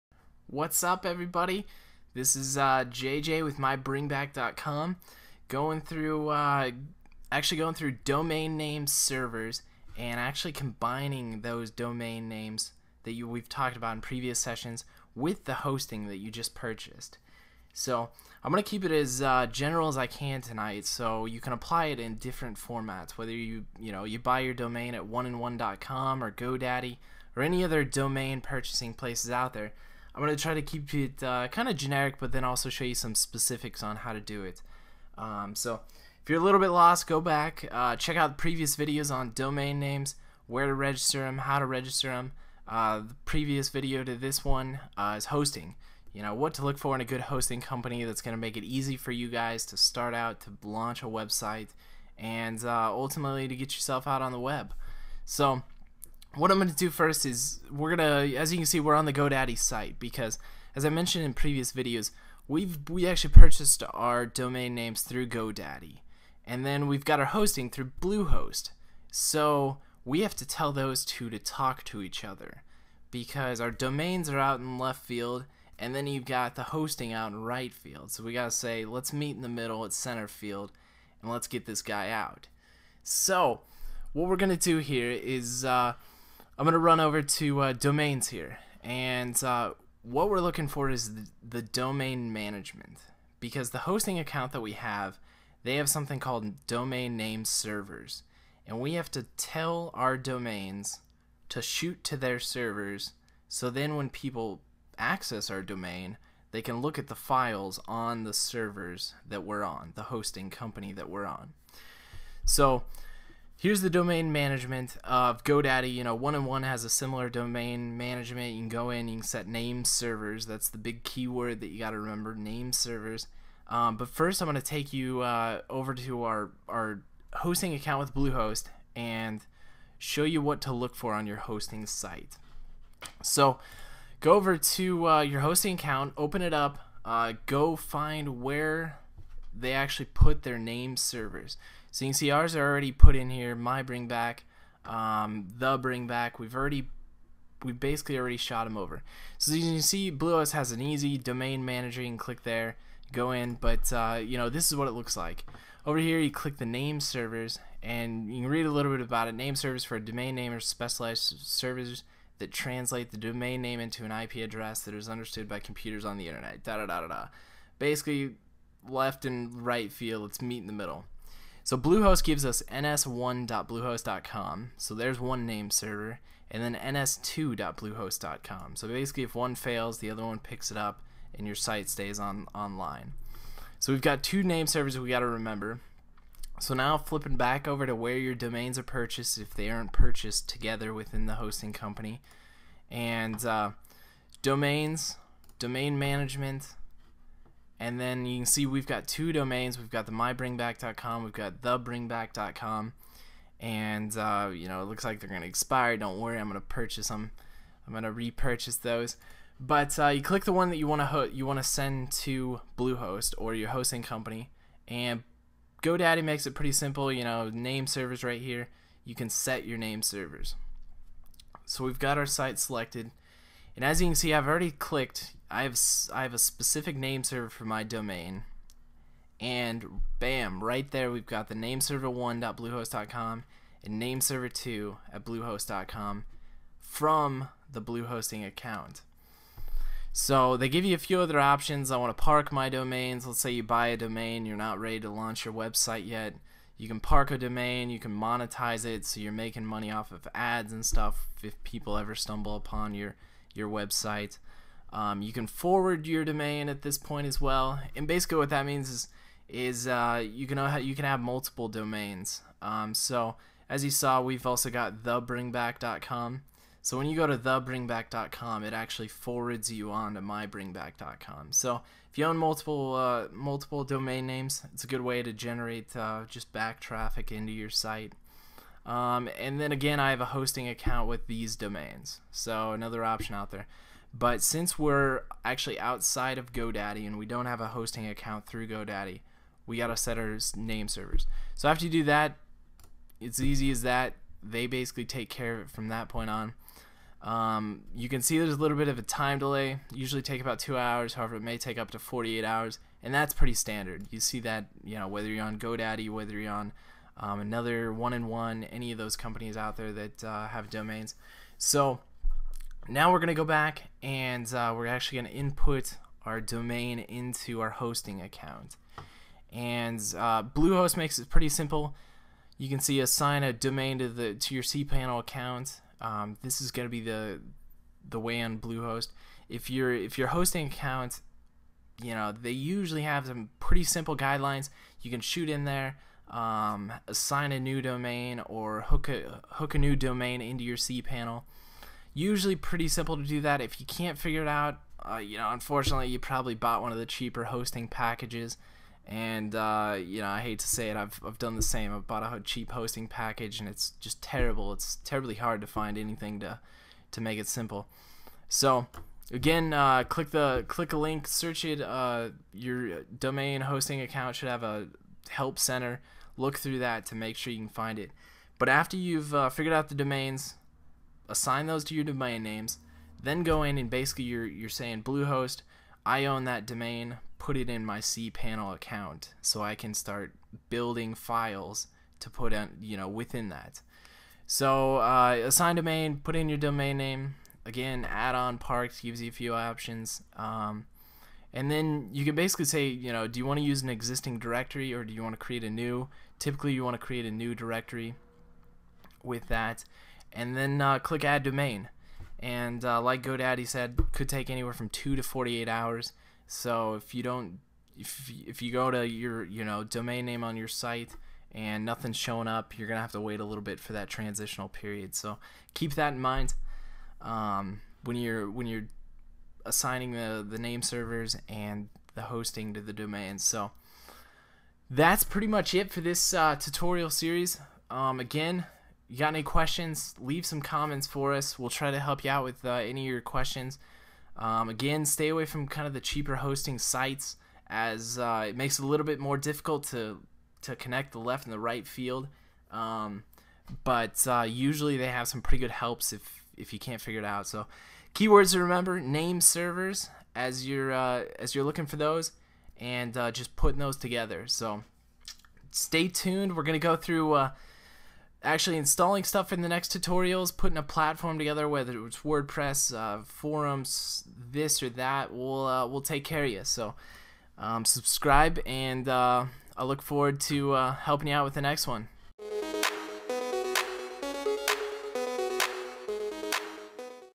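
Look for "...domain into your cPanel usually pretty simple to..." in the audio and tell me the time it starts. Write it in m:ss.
5:39.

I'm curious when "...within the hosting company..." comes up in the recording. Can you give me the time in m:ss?
3:10.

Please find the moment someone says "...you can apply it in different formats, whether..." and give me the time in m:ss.
0:21.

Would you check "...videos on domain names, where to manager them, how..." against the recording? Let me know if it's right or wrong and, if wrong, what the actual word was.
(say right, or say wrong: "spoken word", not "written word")
wrong: "register", not "manager".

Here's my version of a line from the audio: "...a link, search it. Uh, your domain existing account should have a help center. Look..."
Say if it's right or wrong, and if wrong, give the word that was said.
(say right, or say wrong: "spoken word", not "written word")
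wrong: "hosting", not "existing".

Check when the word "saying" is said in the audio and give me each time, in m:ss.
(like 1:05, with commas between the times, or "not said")
6:14.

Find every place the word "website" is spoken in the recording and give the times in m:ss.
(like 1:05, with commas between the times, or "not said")
0:51, 4:05, 4:13.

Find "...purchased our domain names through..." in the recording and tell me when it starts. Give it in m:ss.
1:03.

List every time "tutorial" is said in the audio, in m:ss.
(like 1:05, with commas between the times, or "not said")
7:06, 7:39.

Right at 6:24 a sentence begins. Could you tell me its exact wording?
So uh, assign domain, put in your domain name.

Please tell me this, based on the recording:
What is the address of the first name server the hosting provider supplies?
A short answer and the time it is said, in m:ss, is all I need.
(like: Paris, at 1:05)
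ns1.bluehost.com, at 2:52.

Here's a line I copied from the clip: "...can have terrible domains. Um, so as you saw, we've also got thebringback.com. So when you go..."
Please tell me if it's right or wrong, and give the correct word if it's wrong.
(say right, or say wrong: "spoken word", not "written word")
wrong: "multiple", not "terrible".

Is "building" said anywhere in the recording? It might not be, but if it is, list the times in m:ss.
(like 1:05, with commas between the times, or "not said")
6:20.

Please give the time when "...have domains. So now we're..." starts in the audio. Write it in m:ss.
5:10.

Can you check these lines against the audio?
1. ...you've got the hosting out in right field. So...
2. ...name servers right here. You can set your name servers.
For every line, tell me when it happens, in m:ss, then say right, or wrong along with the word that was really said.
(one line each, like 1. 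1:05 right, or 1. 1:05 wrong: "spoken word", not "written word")
1. 1:16 right
2. 3:37 right.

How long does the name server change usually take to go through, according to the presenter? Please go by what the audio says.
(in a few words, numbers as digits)
2 hours.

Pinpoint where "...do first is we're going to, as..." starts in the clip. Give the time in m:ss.
0:56.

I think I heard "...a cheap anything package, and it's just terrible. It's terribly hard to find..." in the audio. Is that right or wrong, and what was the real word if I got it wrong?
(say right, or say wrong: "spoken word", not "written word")
wrong: "hosting", not "anything".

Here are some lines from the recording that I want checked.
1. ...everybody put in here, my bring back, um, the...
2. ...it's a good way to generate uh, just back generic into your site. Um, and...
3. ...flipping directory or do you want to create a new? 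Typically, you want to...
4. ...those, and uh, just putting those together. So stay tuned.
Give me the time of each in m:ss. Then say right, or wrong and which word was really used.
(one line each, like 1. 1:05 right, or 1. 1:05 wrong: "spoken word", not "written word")
1. 2:22 wrong: "already", not "everybody"
2. 4:34 wrong: "traffic", not "generic"
3. 6:33 wrong: "existing", not "flipping"
4. 7:31 right.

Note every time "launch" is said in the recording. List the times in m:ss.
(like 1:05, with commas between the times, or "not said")
0:50, 4:05.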